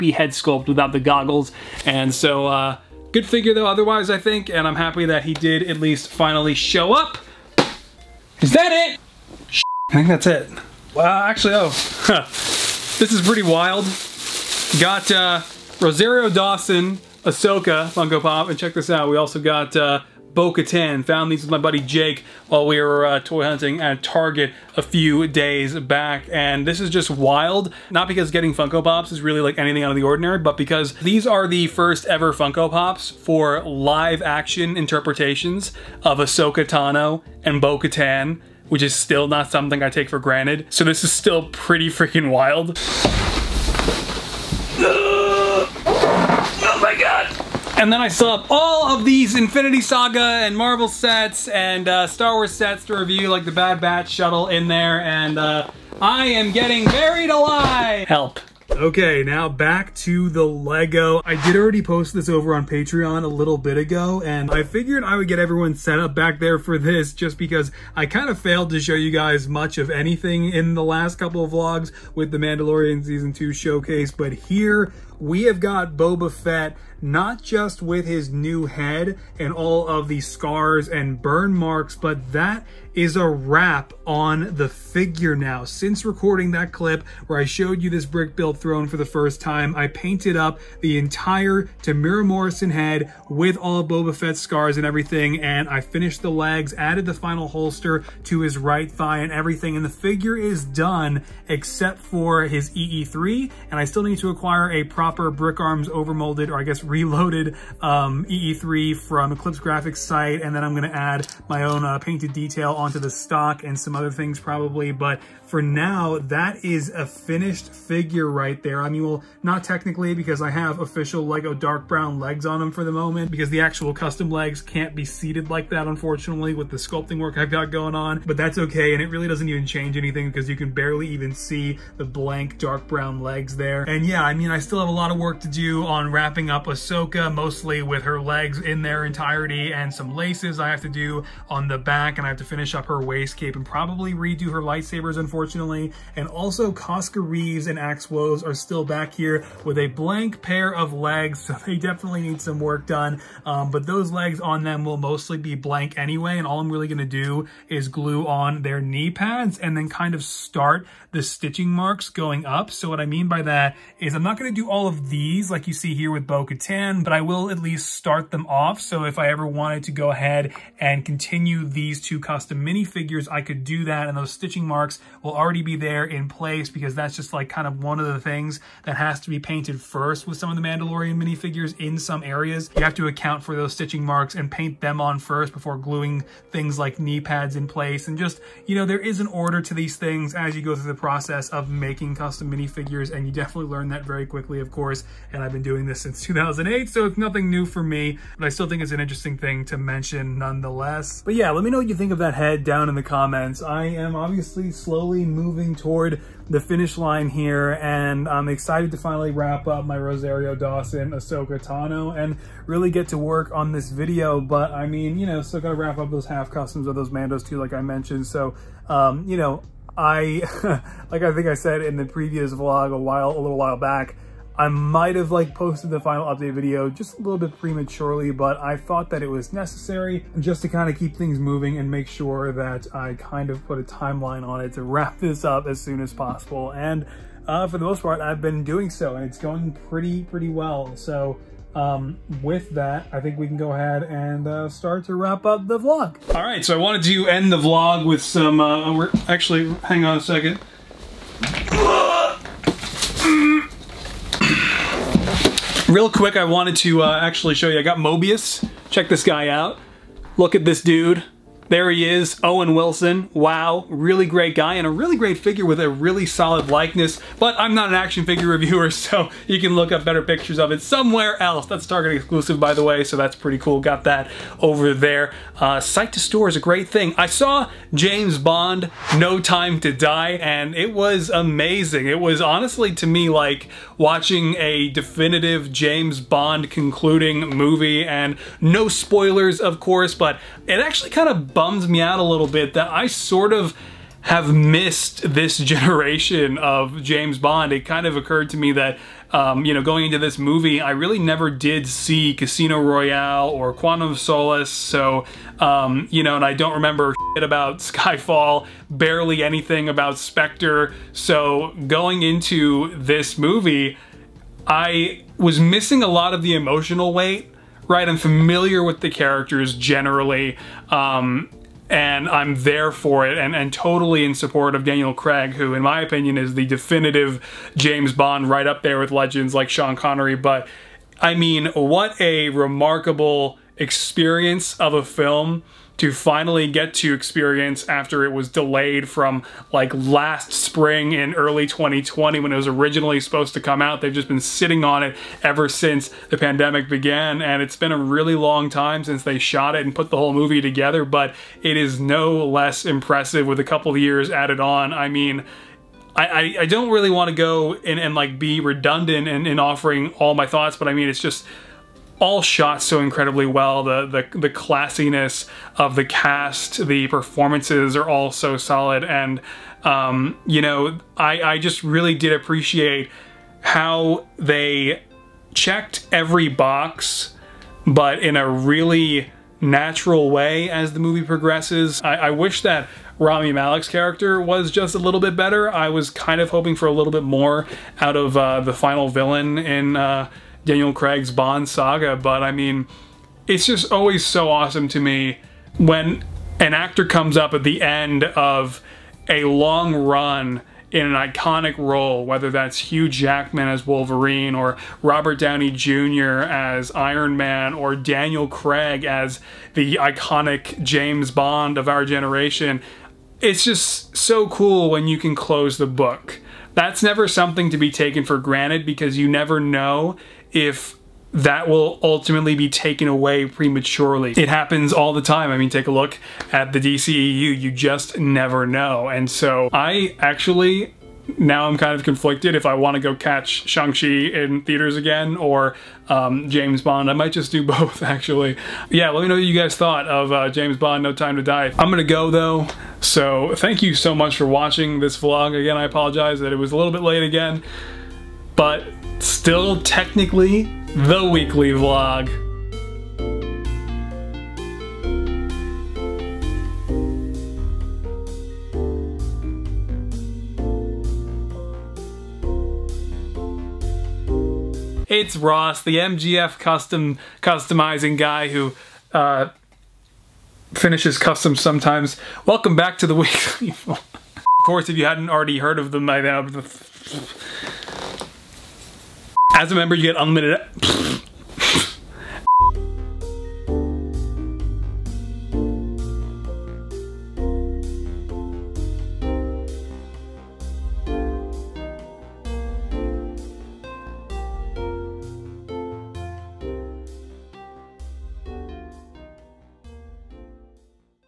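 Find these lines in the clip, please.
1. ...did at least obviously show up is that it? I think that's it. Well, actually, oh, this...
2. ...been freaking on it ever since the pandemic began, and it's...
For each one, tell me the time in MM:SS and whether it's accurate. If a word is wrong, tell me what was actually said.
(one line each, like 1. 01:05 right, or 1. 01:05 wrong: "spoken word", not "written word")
1. 00:05 wrong: "finally", not "obviously"
2. 05:44 wrong: "sitting", not "freaking".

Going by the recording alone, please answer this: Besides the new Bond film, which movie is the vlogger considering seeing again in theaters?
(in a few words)
Shang-Chi.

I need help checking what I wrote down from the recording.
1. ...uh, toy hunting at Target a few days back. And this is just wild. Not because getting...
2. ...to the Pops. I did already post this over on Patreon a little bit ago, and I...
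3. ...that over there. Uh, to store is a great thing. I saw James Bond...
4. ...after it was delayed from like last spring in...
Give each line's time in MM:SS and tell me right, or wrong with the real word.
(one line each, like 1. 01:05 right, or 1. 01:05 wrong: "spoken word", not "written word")
1. 00:23 right
2. 00:59 wrong: "Lego", not "Pops"
3. 04:34 right
4. 05:37 right.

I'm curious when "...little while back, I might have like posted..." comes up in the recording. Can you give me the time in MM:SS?
03:43.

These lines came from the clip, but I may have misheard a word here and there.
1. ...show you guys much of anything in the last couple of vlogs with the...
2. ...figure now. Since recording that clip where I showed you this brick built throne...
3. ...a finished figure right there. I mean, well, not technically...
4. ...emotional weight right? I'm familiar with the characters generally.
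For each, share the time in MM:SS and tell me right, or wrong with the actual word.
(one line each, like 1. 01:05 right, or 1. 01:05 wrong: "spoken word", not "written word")
1. 01:08 right
2. 01:24 right
3. 01:56 right
4. 05:16 right.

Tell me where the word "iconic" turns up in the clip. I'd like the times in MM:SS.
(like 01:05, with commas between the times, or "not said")
06:41, 06:49.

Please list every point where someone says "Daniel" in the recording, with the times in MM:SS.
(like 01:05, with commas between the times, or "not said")
05:24, 06:30, 06:47.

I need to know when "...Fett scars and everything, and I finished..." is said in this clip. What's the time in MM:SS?
01:34.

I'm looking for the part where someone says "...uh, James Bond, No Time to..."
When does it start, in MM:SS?
07:20.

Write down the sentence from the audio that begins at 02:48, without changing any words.
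So if I ever wanted to go ahead and continue these two custom minifigures, I could do that.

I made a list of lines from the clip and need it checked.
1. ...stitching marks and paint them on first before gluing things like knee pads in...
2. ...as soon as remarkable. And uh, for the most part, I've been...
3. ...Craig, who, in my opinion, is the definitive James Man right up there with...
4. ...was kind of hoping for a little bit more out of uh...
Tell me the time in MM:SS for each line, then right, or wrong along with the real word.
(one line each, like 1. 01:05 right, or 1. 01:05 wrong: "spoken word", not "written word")
1. 03:03 right
2. 03:55 wrong: "possible", not "remarkable"
3. 05:25 wrong: "Bond", not "Man"
4. 06:25 right.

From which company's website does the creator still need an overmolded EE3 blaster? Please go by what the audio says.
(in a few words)
Eclipse Graphics.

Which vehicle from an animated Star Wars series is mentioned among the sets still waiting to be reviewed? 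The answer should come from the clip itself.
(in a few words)
Bad Batch shuttle.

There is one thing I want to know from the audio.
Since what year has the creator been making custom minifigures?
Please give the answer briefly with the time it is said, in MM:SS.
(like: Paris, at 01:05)
2008, at 03:16.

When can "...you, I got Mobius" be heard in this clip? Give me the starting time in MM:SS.
04:17.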